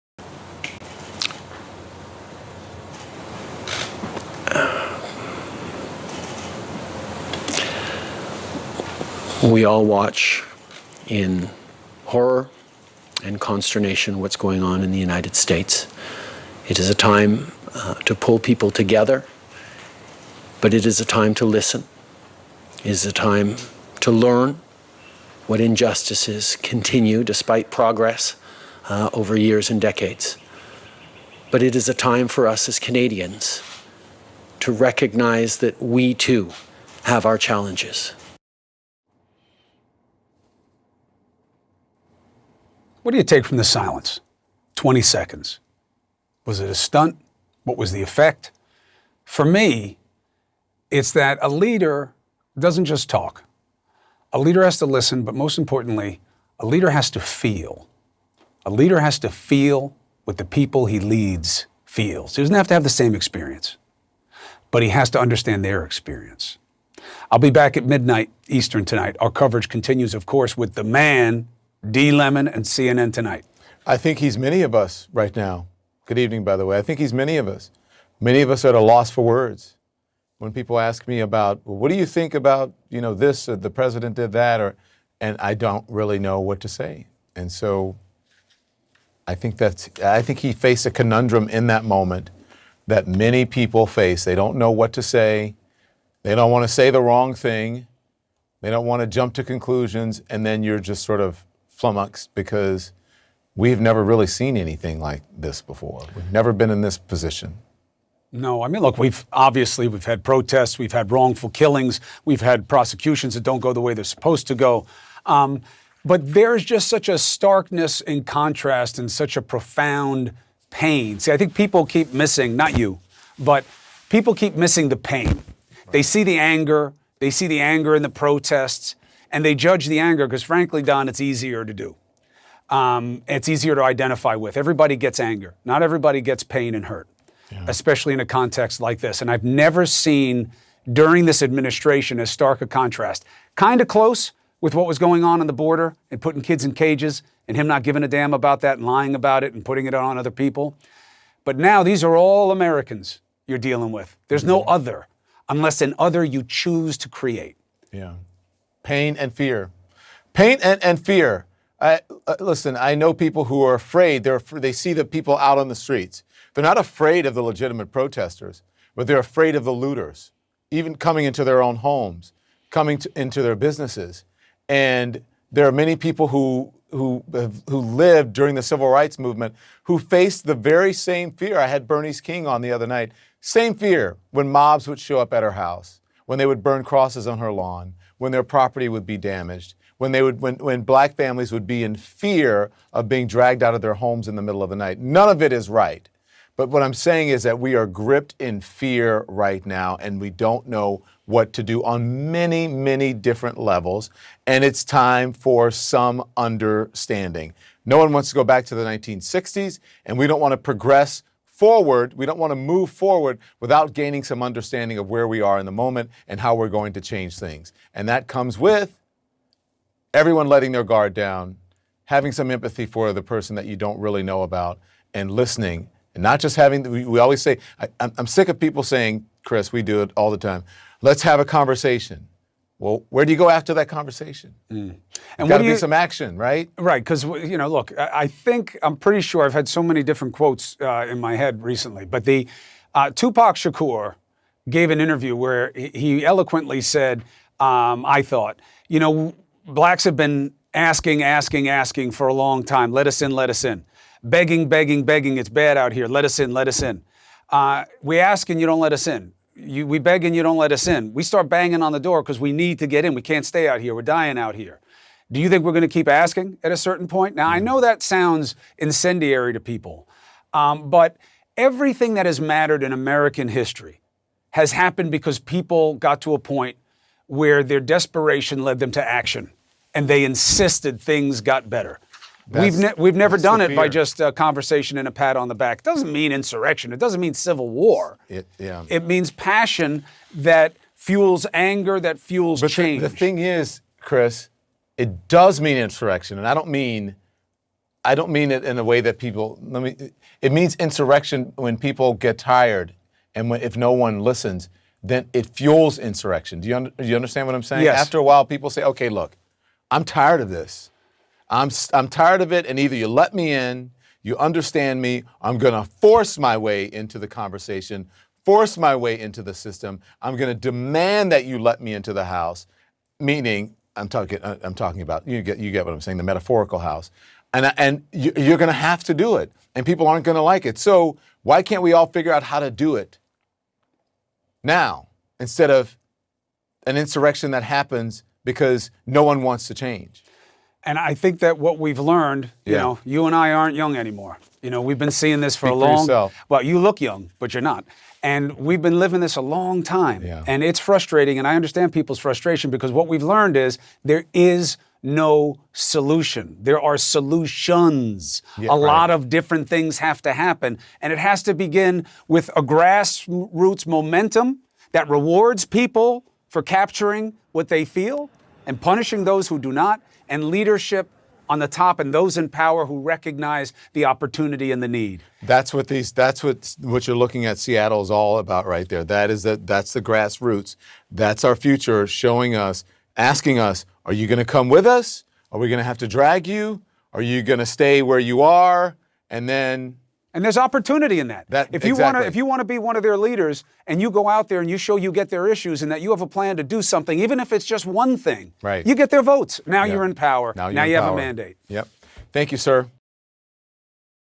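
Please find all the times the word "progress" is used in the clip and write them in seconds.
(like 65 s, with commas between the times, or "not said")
27 s, 210 s.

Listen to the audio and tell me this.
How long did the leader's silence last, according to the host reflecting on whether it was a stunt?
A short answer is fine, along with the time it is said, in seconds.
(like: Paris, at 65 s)
20 seconds, at 44 s.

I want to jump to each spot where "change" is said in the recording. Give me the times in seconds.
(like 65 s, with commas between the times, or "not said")
216 s, 292 s, 339 s.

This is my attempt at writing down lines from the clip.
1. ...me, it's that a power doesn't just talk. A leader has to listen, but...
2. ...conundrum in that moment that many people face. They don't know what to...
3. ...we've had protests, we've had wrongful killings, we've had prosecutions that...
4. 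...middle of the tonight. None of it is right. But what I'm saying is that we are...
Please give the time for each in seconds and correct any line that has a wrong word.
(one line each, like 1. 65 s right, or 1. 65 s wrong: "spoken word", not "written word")
1. 49 s wrong: "leader", not "power"
2. 90 s right
3. 109 s right
4. 194 s wrong: "night", not "tonight".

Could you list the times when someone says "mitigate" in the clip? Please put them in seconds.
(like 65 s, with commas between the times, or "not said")
not said.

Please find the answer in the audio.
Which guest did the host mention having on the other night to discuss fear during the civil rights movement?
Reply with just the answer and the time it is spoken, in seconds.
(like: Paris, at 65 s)
Bernice King, at 181 s.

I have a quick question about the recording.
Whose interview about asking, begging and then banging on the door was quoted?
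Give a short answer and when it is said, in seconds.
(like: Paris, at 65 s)
Tupac Shakur, at 243 s.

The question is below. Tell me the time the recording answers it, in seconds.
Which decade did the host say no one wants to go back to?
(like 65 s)
208 s.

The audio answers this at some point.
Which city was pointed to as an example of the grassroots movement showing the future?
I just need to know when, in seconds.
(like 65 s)
377 s.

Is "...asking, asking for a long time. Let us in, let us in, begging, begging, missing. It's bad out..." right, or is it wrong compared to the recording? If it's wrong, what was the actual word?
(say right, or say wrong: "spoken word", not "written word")
wrong: "begging", not "missing".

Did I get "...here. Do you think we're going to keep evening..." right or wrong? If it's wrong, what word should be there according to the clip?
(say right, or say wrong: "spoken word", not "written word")
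wrong: "asking", not "evening".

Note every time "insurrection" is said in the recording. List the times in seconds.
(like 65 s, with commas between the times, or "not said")
286 s, 295 s, 300 s, 305 s, 336 s.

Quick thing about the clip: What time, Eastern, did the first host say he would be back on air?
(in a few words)
midnight.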